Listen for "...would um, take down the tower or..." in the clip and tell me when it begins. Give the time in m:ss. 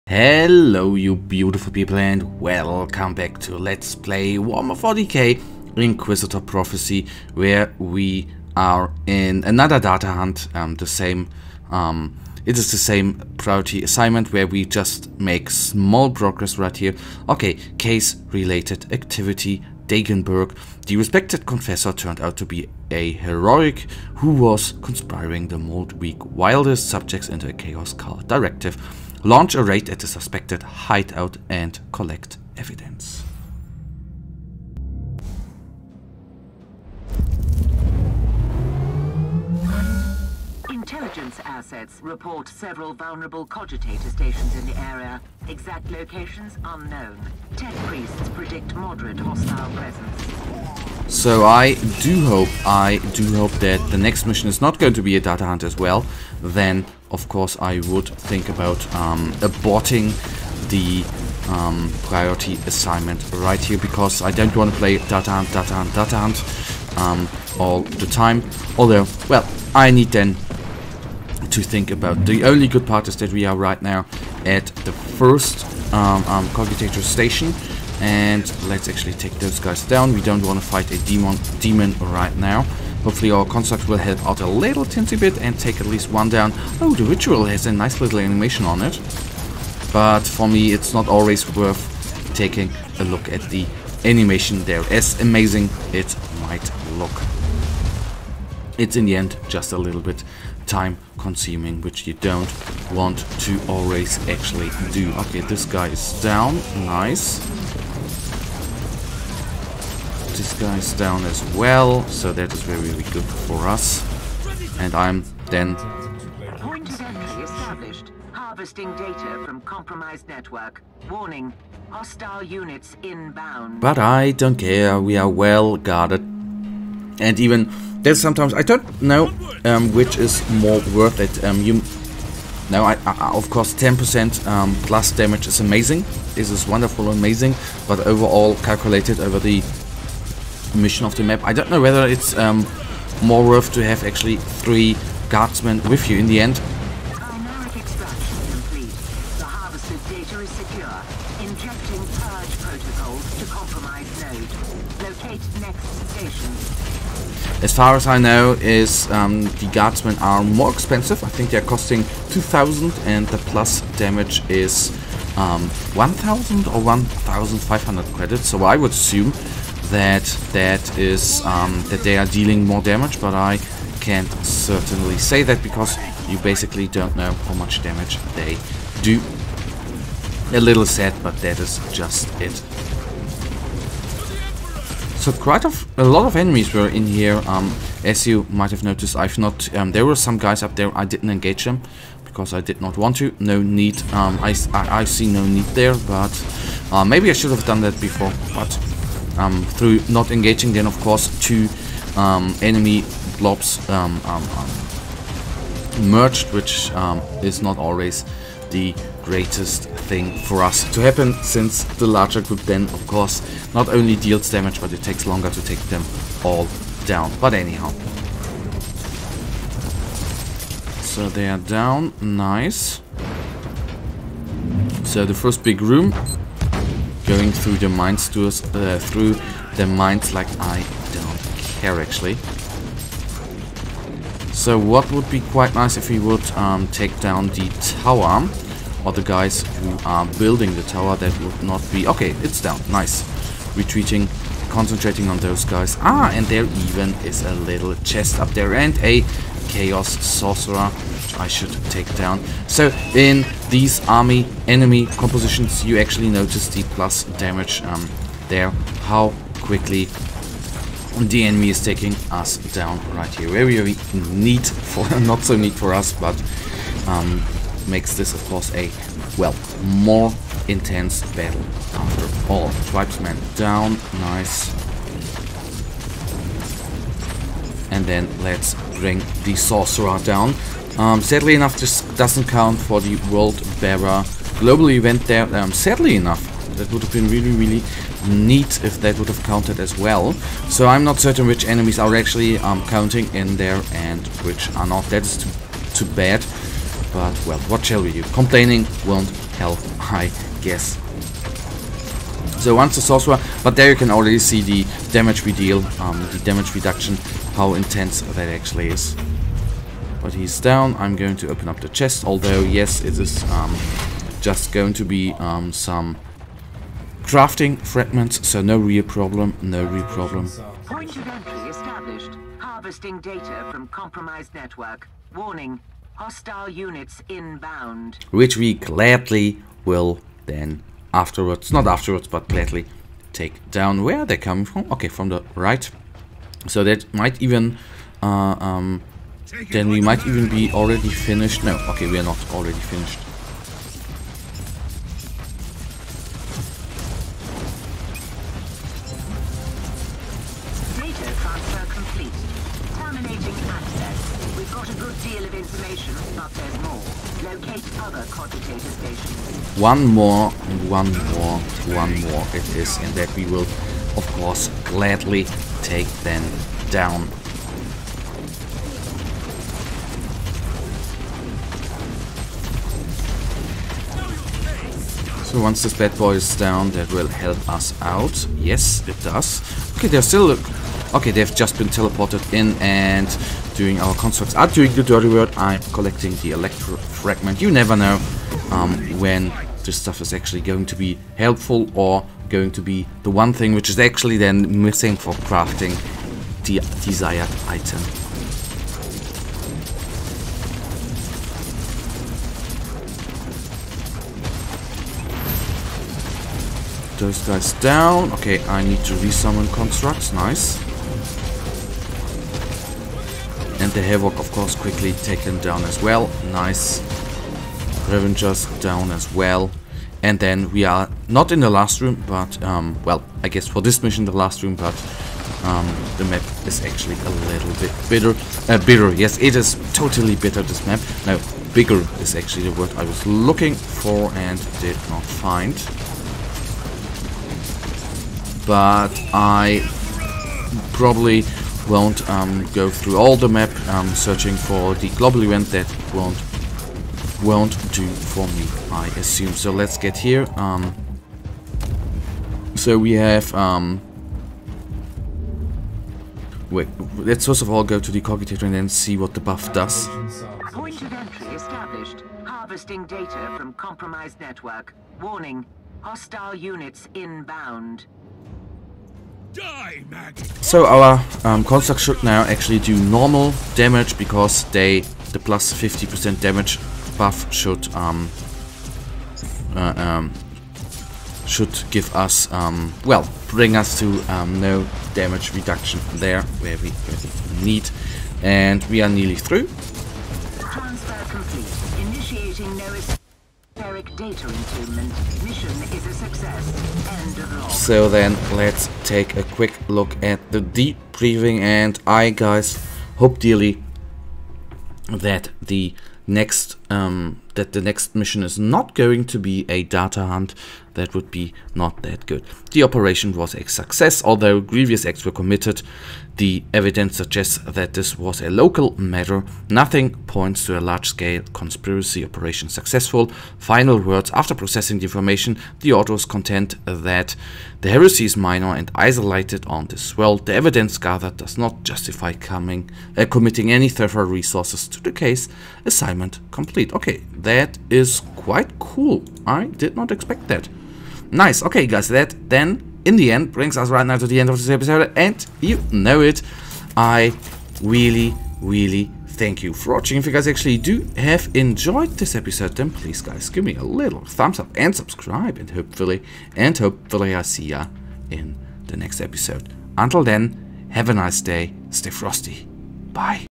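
3:56.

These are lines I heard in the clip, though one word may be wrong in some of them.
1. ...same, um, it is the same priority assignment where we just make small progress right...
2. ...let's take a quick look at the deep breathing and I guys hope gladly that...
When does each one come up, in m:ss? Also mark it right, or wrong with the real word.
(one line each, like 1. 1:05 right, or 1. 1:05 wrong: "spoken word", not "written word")
1. 0:10 right
2. 8:18 wrong: "dearly", not "gladly".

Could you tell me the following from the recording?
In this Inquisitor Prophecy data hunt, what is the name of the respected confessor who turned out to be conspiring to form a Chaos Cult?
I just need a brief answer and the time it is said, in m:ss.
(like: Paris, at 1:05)
Dagenberg, at 0:19.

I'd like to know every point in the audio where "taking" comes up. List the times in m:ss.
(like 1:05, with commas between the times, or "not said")
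1:32, 4:21.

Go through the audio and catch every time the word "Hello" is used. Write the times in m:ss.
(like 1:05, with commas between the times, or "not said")
0:00.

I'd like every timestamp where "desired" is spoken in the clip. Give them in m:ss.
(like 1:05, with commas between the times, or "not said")
6:37.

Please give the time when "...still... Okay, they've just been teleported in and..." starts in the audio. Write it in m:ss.
6:20.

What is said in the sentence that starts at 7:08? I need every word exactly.
Uh, bitter, yes, it is totally bitter, this map.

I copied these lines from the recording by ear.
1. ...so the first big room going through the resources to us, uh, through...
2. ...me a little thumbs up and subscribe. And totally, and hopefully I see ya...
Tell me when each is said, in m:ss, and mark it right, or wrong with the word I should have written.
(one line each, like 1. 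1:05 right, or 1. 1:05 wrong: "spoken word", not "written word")
1. 3:45 wrong: "mines", not "resources"
2. 9:13 wrong: "hopefully", not "totally".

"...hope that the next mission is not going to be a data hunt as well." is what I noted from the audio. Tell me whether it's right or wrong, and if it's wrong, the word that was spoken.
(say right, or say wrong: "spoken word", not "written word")
right.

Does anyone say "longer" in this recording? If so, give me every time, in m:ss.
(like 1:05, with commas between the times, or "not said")
3:35.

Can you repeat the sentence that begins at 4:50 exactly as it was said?
So I'm not certain which enemies are actually um, counting in there and which are not.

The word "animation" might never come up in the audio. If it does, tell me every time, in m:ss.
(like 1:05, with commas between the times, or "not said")
1:28, 1:34.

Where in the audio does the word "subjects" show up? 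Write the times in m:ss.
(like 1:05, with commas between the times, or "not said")
0:26.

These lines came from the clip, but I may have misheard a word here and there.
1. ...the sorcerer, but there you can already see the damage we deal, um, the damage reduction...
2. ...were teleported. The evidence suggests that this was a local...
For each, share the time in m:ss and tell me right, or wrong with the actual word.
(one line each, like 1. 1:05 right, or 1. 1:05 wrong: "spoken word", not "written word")
1. 5:02 right
2. 8:35 wrong: "committed", not "teleported".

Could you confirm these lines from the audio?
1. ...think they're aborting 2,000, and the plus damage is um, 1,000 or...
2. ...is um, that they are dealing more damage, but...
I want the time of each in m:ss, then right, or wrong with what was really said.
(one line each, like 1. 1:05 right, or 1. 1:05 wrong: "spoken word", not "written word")
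1. 2:41 wrong: "costing", not "aborting"
2. 2:50 right.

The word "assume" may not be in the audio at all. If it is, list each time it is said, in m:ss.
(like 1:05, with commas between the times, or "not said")
2:48, 7:29.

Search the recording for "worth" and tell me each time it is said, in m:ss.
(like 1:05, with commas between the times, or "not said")
1:31, 2:10, 2:23.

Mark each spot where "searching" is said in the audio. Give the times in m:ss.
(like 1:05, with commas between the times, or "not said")
7:24.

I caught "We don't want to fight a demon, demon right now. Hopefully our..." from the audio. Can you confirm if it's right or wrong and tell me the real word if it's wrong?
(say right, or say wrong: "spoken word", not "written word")
right.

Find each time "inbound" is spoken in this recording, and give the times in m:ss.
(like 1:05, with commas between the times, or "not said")
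2:03, 5:27, 7:47.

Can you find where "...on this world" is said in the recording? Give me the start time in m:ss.
8:49.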